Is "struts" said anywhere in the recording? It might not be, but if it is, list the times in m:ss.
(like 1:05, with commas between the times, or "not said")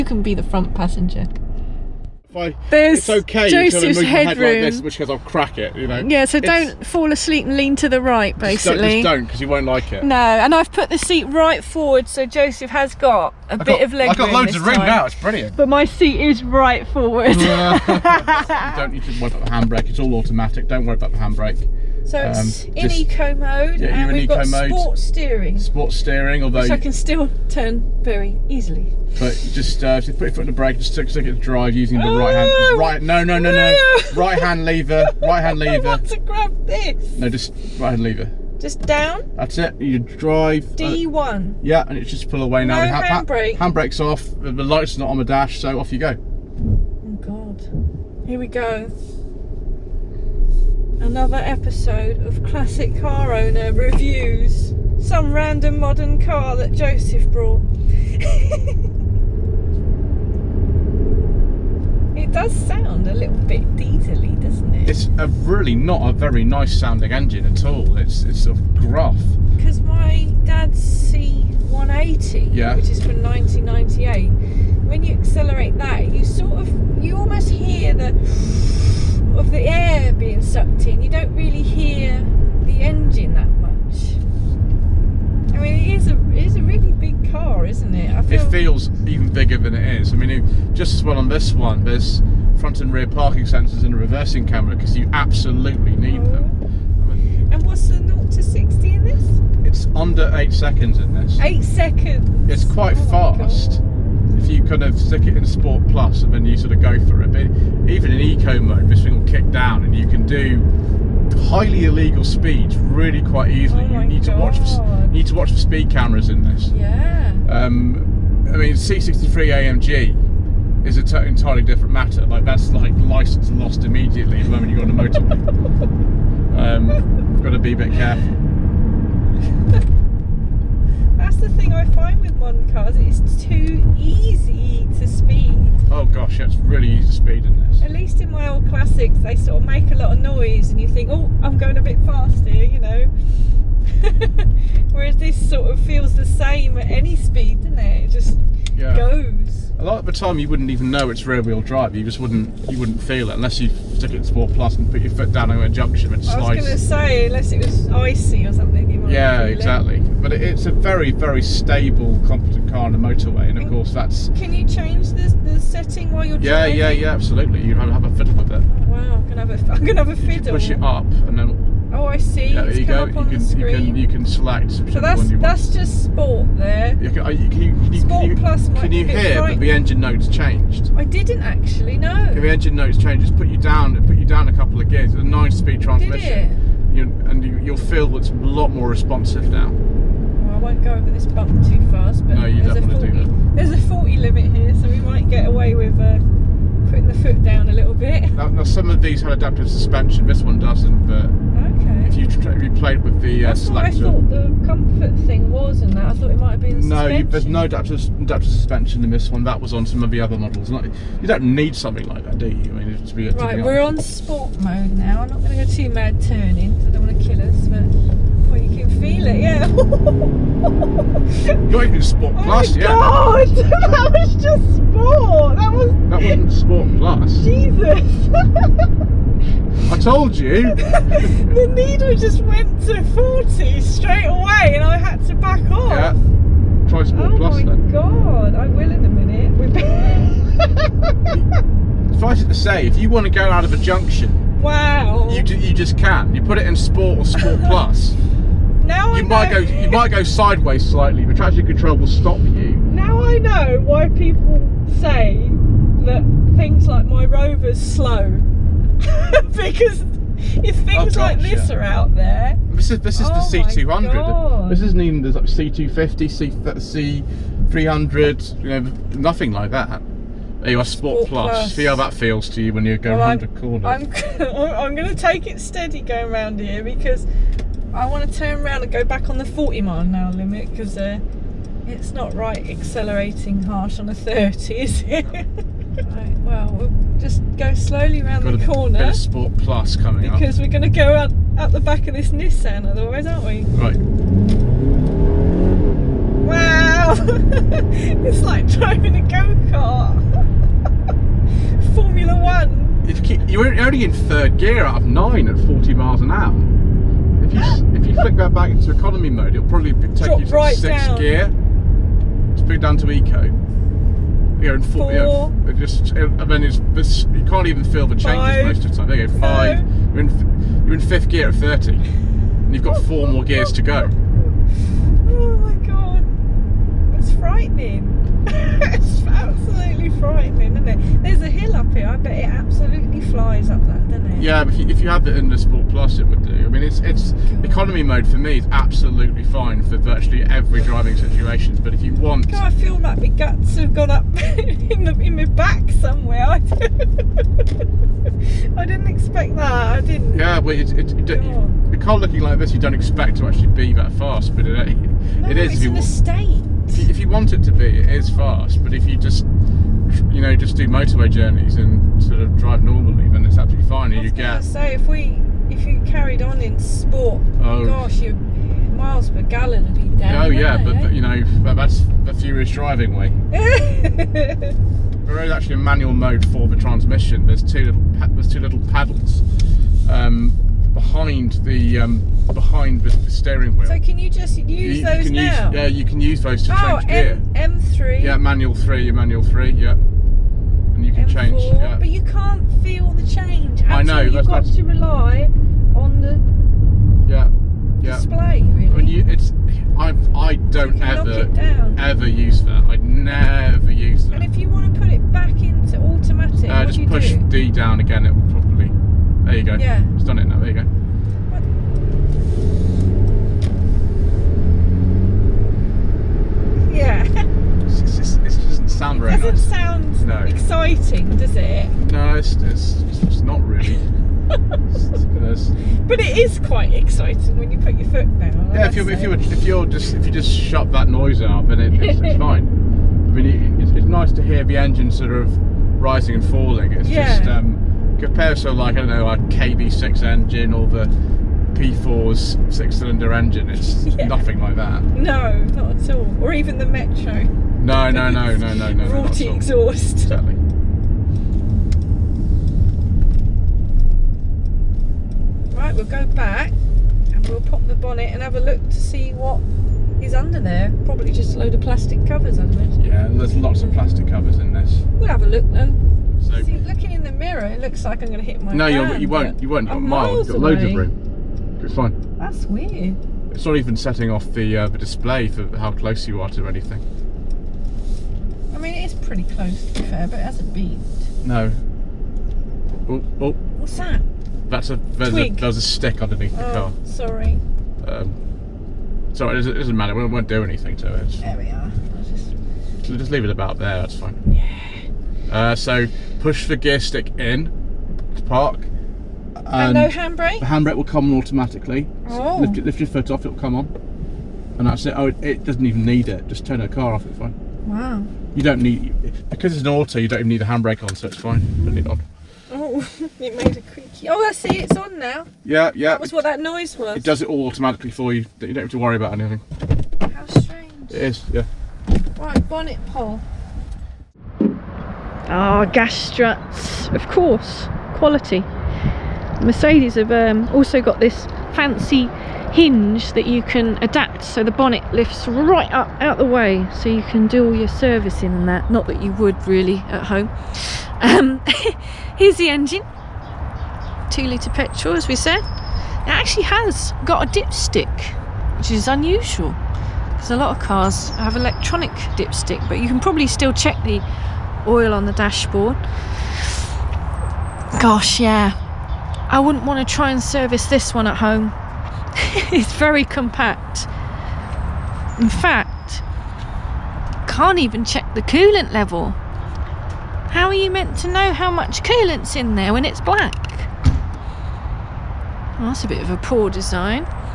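8:46.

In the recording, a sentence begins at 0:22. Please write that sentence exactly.
So it's um, in just, eco mode, yeah, and we've got mode, sport steering.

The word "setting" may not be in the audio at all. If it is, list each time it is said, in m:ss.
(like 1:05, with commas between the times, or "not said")
2:45, 7:53.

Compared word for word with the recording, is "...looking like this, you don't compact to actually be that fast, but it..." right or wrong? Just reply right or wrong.
wrong.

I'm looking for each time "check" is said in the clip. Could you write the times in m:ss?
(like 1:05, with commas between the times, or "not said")
9:13, 9:28.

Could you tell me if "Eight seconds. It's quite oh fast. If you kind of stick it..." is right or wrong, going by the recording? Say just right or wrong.
right.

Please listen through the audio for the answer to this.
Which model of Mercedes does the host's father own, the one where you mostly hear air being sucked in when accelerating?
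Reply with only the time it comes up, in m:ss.
1:10.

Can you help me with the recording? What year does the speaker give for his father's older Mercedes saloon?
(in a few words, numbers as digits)
1998.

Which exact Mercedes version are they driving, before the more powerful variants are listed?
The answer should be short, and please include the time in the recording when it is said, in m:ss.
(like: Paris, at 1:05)
C200, at 4:23.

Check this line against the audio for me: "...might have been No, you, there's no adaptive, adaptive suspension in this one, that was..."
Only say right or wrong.
right.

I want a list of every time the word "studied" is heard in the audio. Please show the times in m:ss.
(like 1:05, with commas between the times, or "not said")
not said.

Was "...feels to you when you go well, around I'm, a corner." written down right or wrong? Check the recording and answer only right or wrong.
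right.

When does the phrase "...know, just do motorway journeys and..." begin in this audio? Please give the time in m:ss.
6:00.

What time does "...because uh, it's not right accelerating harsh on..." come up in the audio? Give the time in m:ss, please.
4:40.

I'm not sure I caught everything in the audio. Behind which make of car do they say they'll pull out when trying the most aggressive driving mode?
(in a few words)
Nissan.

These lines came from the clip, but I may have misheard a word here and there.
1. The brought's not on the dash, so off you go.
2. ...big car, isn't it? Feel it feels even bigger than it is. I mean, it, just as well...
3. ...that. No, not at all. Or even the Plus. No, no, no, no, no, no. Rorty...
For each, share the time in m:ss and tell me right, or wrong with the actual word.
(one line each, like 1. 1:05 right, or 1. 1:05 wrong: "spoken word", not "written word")
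1. 0:44 wrong: "light", not "brought"
2. 1:26 right
3. 7:24 wrong: "Metro", not "Plus".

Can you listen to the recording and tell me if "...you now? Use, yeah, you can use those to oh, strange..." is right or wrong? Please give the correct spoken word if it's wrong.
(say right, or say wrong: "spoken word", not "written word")
wrong: "change", not "strange".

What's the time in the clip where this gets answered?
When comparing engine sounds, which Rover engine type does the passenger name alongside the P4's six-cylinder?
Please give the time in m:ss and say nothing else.
7:19.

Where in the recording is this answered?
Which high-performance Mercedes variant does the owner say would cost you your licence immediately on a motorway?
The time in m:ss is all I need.
1:58.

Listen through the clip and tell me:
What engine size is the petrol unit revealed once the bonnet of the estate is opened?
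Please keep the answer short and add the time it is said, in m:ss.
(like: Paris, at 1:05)
2 litre, at 9:04.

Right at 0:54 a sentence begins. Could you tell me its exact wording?
Some random modern car that Joseph brought.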